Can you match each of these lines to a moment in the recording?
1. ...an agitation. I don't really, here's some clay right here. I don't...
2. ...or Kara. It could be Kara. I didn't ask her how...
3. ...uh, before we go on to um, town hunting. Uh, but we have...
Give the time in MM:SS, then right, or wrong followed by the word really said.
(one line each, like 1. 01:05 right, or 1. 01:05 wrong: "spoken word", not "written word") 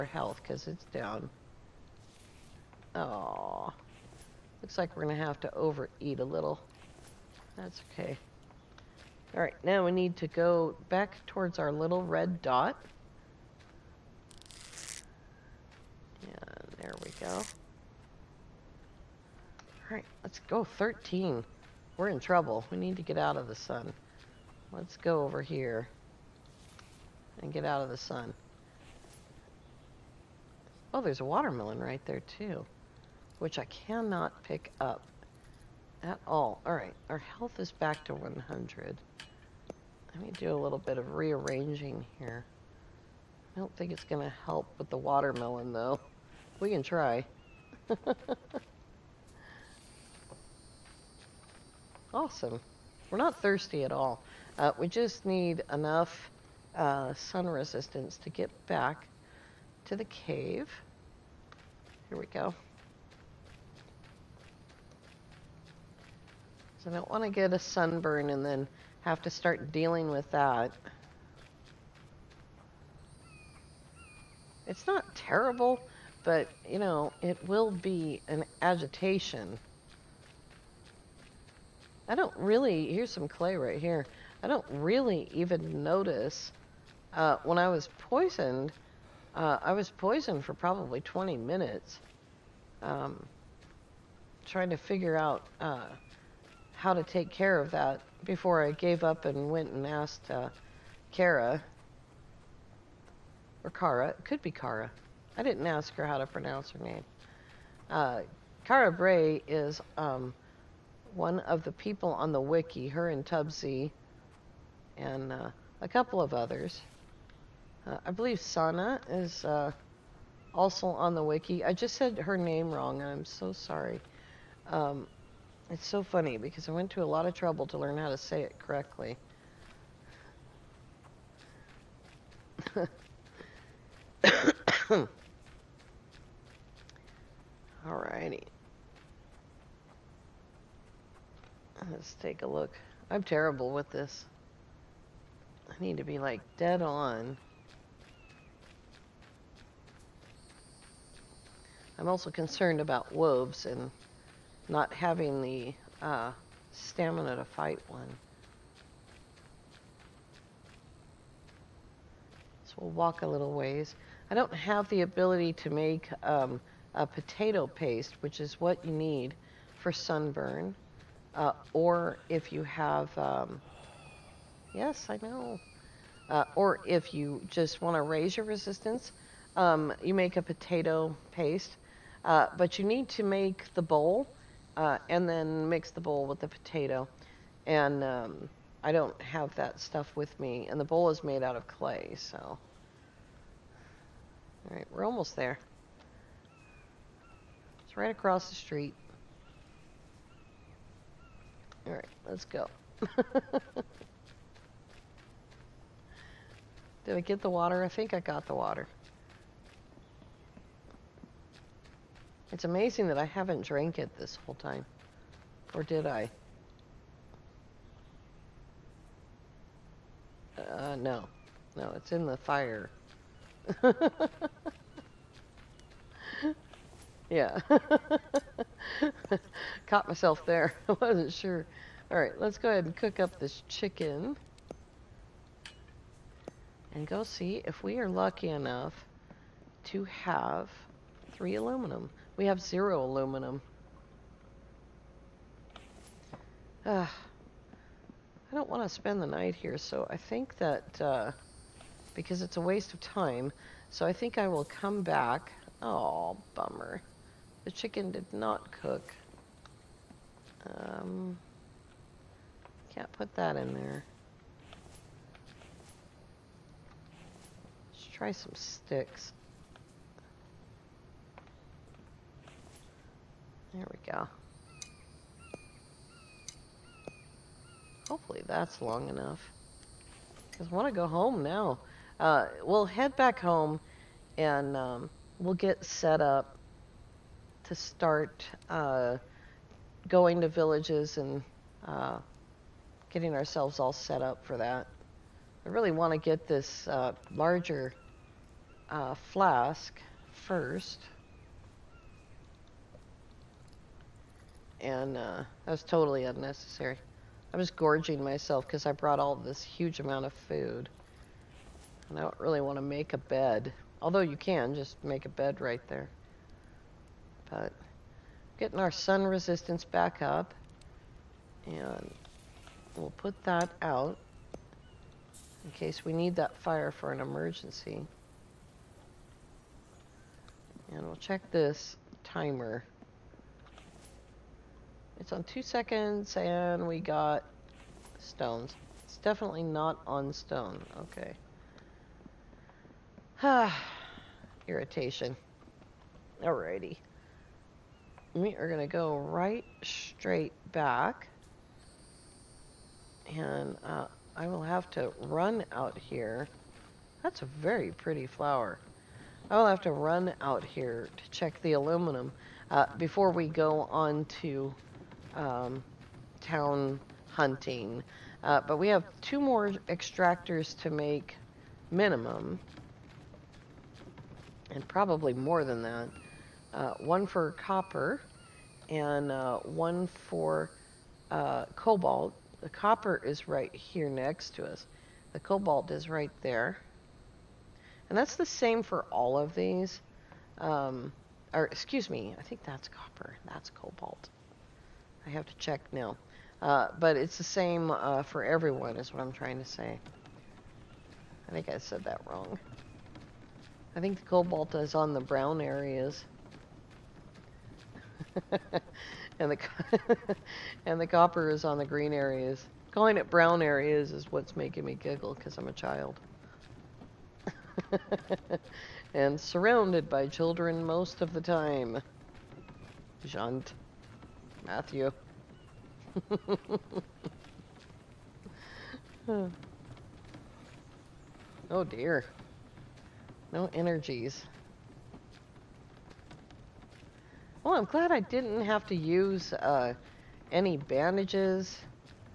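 1. 01:18 right
2. 01:43 right
3. 06:02 right.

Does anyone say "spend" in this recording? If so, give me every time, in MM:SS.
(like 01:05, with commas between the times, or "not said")
04:08.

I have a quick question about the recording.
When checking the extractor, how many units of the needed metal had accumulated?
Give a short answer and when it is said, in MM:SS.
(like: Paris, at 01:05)
Zero, at 04:02.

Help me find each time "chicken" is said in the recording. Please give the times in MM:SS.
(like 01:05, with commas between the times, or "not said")
03:53, 04:17.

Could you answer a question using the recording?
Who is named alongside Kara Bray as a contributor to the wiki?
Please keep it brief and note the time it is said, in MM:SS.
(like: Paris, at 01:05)
Tubbsy, at 01:53.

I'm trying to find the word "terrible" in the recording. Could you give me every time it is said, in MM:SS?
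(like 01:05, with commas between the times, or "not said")
01:15, 02:23.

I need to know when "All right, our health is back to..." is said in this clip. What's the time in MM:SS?
00:36.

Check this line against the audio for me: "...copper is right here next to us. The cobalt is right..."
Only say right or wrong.
right.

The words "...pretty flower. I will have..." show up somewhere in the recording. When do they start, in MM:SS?
05:57.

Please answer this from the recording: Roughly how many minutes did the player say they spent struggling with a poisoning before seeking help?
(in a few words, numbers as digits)
20.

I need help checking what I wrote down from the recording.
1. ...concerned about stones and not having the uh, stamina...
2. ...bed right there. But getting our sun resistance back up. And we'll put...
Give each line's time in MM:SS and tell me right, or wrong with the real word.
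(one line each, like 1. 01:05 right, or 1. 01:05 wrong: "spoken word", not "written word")
1. 02:32 wrong: "wolves", not "stones"
2. 05:15 right.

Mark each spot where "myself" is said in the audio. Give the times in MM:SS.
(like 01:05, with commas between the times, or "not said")
03:50, 05:08.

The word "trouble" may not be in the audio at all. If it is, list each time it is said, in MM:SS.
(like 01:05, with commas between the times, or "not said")
00:22, 02:07.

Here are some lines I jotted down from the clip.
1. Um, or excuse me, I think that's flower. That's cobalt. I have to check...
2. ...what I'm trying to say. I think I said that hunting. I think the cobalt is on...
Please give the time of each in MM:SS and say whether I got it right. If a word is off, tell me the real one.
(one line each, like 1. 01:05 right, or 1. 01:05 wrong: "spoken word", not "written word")
1. 06:30 wrong: "copper", not "flower"
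2. 06:39 wrong: "wrong", not "hunting".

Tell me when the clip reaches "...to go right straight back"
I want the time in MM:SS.
05:48.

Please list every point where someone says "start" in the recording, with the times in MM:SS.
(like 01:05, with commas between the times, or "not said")
01:09, 04:47.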